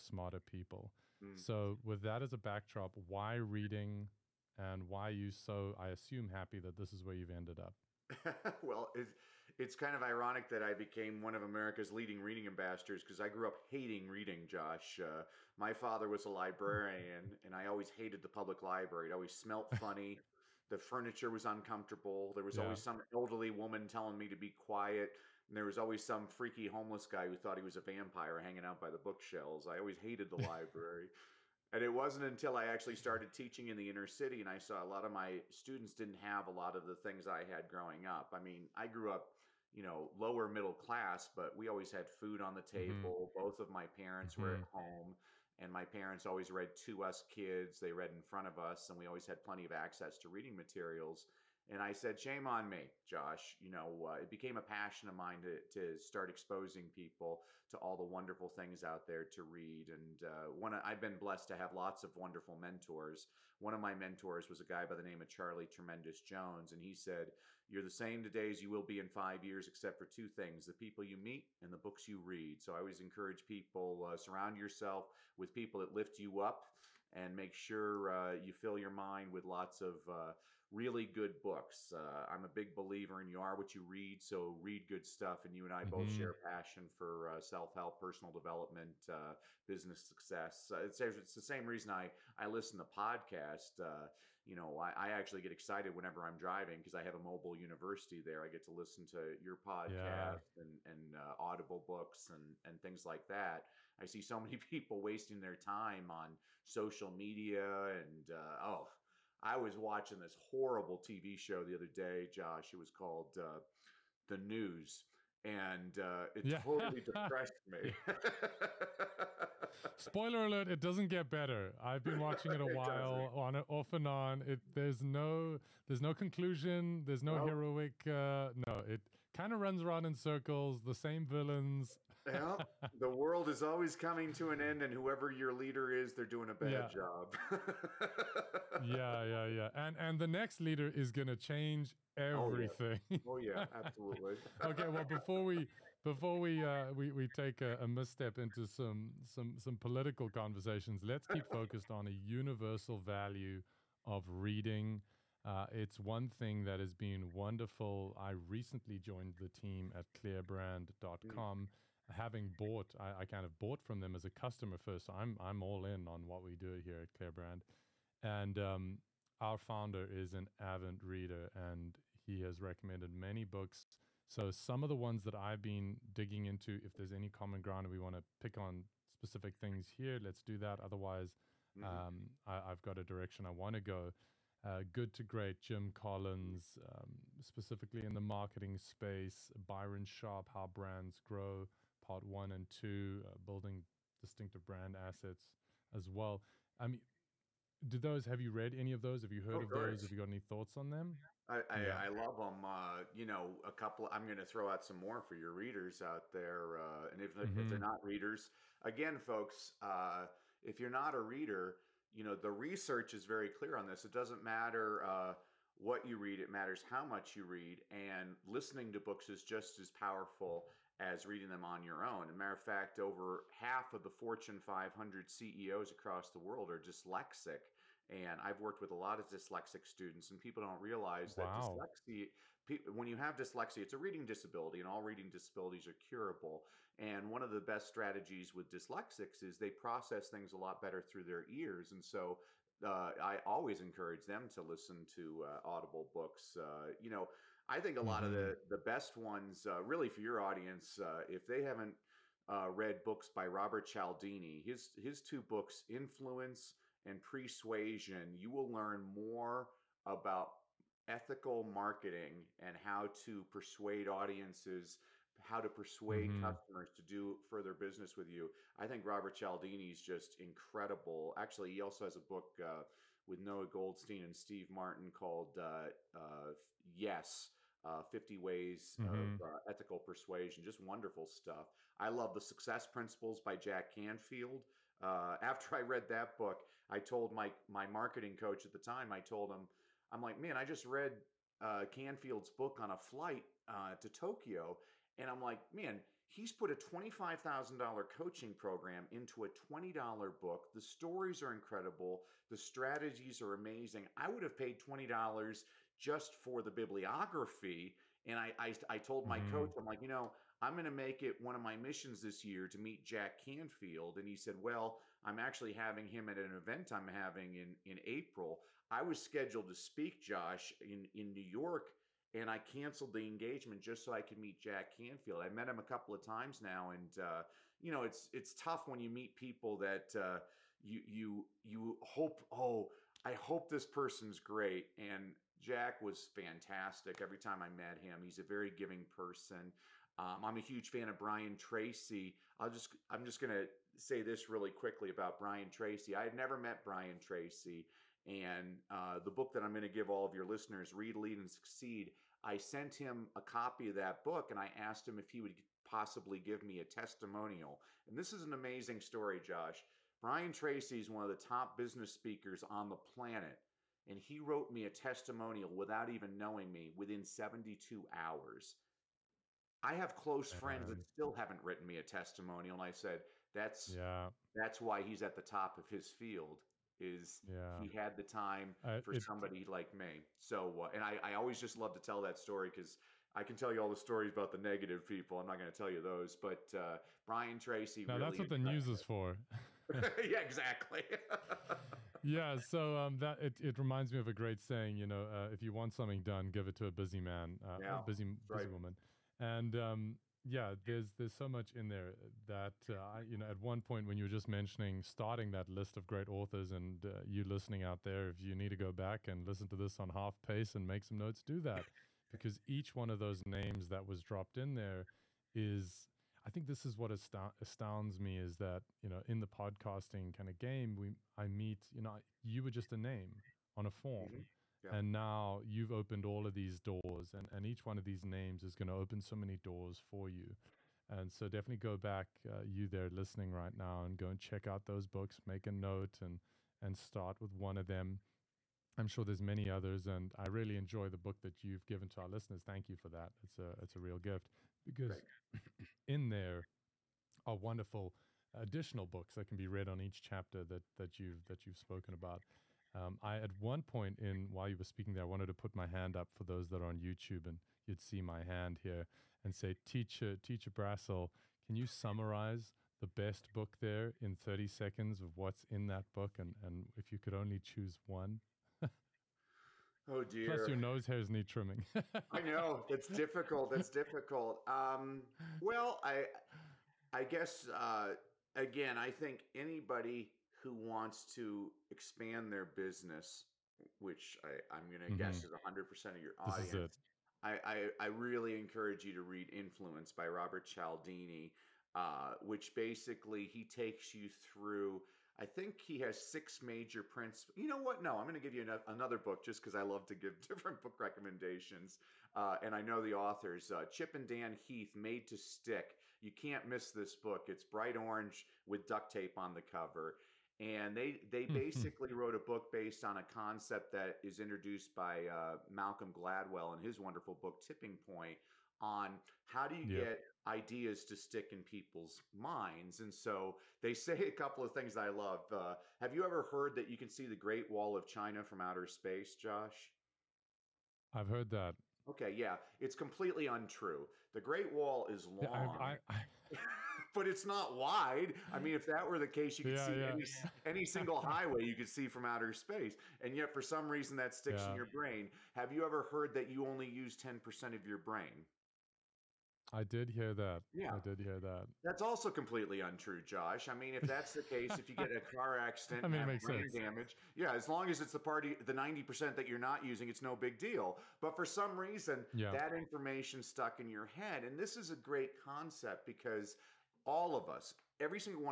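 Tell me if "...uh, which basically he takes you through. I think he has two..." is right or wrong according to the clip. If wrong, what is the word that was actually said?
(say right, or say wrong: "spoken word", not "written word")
wrong: "six", not "two".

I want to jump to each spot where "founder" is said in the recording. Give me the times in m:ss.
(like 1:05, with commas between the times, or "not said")
2:49.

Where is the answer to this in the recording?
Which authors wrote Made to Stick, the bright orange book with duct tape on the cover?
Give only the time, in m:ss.
8:23.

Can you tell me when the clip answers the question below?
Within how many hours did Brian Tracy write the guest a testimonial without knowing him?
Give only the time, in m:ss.
6:07.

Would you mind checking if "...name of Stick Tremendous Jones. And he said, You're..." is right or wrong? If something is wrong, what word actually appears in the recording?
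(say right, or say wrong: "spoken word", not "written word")
wrong: "Charlie", not "Stick".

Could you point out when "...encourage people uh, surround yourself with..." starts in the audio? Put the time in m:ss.
1:13.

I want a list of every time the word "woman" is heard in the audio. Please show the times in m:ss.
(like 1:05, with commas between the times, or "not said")
0:23, 6:38.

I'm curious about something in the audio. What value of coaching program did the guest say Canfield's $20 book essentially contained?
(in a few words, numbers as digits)
$25,000.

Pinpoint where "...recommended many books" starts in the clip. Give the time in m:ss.
2:52.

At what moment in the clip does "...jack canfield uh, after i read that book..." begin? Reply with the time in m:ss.
4:43.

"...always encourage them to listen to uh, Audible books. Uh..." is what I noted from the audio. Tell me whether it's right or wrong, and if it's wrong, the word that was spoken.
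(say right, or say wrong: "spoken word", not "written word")
right.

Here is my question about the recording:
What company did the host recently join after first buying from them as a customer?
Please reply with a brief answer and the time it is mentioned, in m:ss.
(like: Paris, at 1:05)
Clearbrand, at 2:40.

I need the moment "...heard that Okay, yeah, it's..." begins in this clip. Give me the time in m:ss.
8:51.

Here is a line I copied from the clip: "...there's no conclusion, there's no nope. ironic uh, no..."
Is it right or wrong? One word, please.
wrong.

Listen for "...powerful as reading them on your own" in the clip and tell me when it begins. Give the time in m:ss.
3:39.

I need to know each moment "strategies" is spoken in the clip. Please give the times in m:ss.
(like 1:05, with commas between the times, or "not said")
3:57, 5:02.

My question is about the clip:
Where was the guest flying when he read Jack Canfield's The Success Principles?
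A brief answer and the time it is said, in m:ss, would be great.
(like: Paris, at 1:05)
Tokyo, at 4:54.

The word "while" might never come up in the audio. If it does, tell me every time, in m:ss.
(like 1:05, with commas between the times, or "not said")
2:02, 7:34.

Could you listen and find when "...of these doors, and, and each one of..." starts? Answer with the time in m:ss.
7:06.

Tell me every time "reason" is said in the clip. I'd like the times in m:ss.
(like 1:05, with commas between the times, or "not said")
1:31, 9:03, 9:21.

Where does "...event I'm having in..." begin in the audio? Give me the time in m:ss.
5:16.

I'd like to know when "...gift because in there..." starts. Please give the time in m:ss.
7:24.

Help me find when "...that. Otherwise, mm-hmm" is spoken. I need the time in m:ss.
3:00.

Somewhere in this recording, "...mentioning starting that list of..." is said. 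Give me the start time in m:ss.
6:44.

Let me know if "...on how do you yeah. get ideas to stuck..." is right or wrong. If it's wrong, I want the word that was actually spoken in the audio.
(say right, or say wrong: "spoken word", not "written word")
wrong: "stick", not "stuck".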